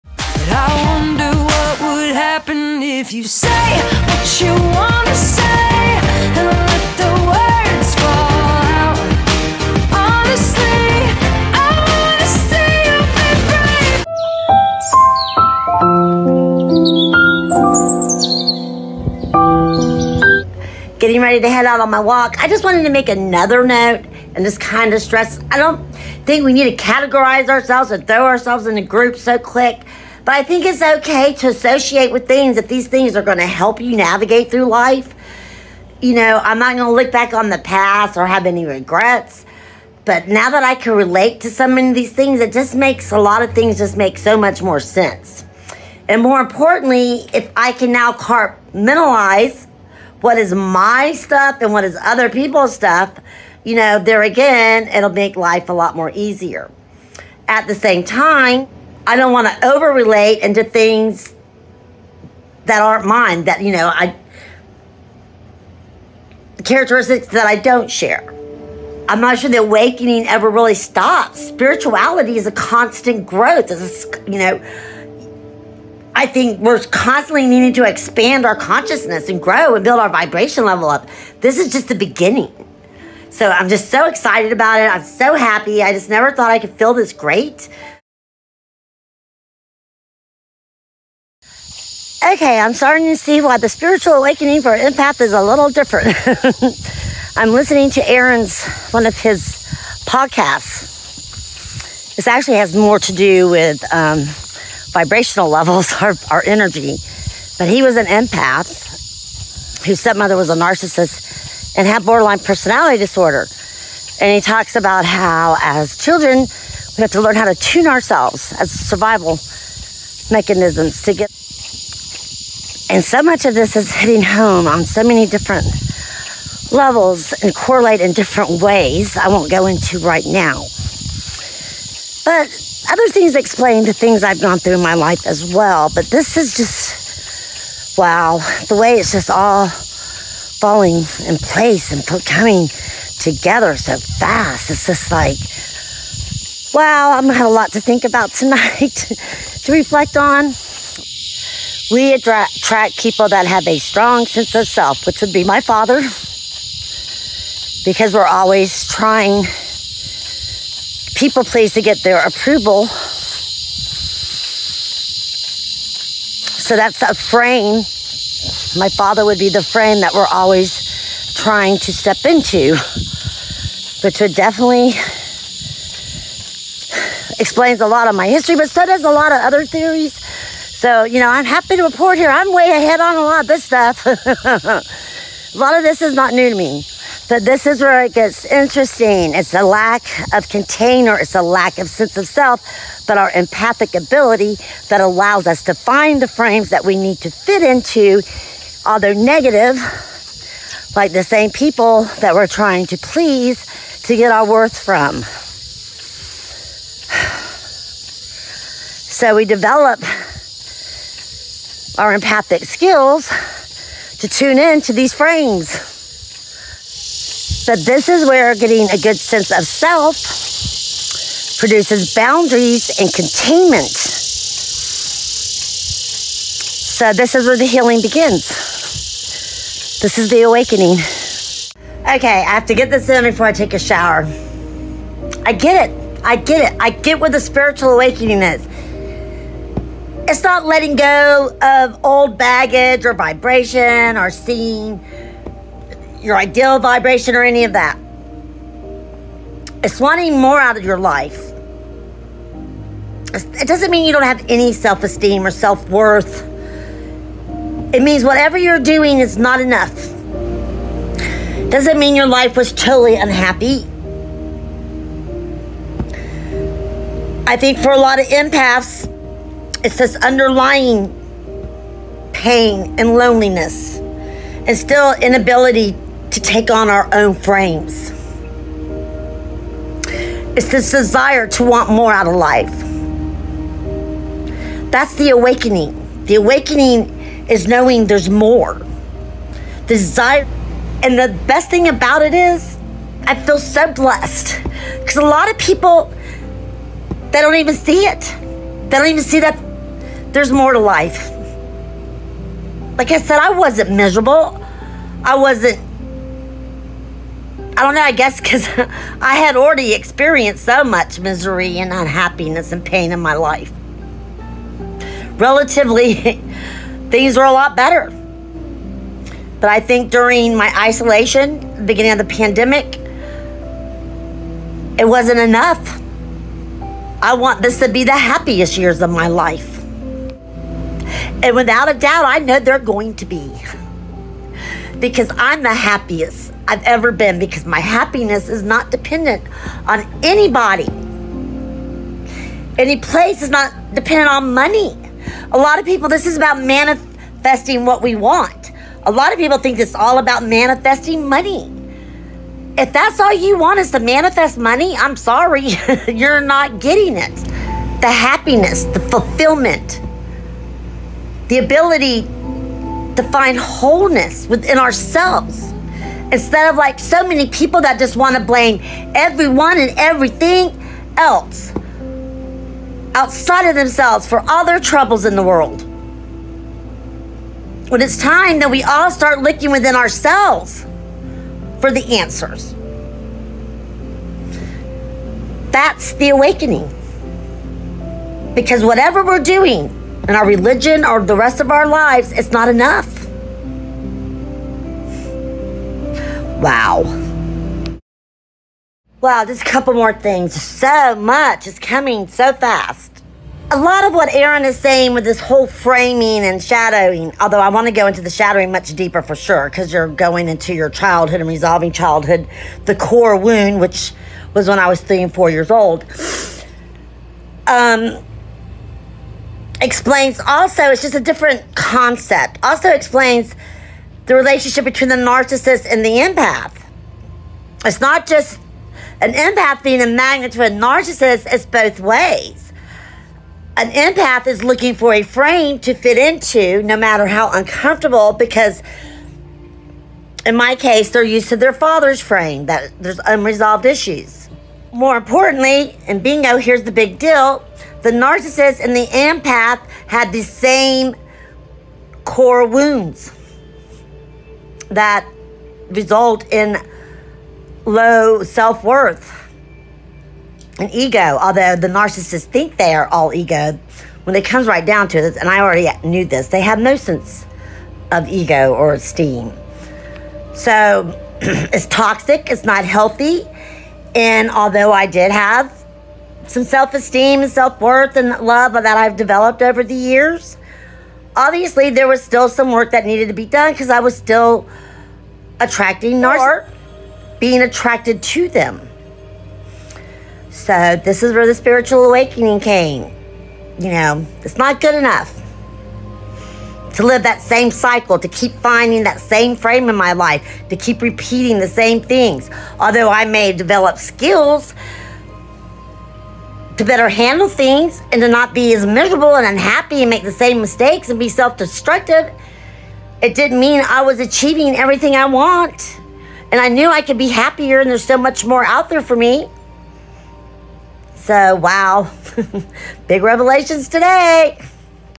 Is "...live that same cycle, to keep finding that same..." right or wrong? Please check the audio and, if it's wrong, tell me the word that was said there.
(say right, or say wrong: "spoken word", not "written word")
right.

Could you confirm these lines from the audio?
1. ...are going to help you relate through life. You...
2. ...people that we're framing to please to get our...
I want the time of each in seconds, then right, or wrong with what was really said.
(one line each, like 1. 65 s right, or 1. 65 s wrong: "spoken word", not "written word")
1. 33 s wrong: "navigate", not "relate"
2. 201 s wrong: "trying", not "framing".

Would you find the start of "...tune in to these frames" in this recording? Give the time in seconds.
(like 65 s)
214 s.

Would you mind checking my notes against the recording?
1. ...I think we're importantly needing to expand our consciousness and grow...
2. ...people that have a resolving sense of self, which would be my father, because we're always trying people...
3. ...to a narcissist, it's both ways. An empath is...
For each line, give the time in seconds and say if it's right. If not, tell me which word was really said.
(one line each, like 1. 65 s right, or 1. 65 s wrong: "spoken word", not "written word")
1. 76 s wrong: "constantly", not "importantly"
2. 152 s wrong: "strong", not "resolving"
3. 430 s right.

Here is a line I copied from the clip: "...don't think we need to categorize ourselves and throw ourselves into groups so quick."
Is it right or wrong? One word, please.
right.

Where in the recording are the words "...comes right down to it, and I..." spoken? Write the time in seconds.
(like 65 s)
464 s.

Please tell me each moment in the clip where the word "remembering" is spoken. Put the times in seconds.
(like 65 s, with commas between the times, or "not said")
not said.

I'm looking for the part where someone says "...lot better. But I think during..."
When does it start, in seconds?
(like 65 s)
317 s.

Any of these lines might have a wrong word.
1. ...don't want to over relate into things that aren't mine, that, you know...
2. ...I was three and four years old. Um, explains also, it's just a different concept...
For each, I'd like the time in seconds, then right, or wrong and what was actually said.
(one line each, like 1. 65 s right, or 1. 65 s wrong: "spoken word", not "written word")
1. 59 s right
2. 414 s right.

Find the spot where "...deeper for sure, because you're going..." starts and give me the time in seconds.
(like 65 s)
408 s.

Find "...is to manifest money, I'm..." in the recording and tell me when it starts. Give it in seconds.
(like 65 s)
353 s.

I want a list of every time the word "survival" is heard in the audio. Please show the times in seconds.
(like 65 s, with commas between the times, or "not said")
118 s.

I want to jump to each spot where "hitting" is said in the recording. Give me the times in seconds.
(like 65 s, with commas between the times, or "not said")
123 s.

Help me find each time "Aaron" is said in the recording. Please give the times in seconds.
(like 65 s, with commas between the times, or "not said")
98 s, 404 s.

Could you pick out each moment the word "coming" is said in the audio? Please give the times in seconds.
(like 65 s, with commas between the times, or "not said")
142 s, 401 s.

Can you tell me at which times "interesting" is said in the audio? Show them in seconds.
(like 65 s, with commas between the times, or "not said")
188 s.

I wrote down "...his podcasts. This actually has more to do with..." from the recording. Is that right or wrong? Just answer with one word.
right.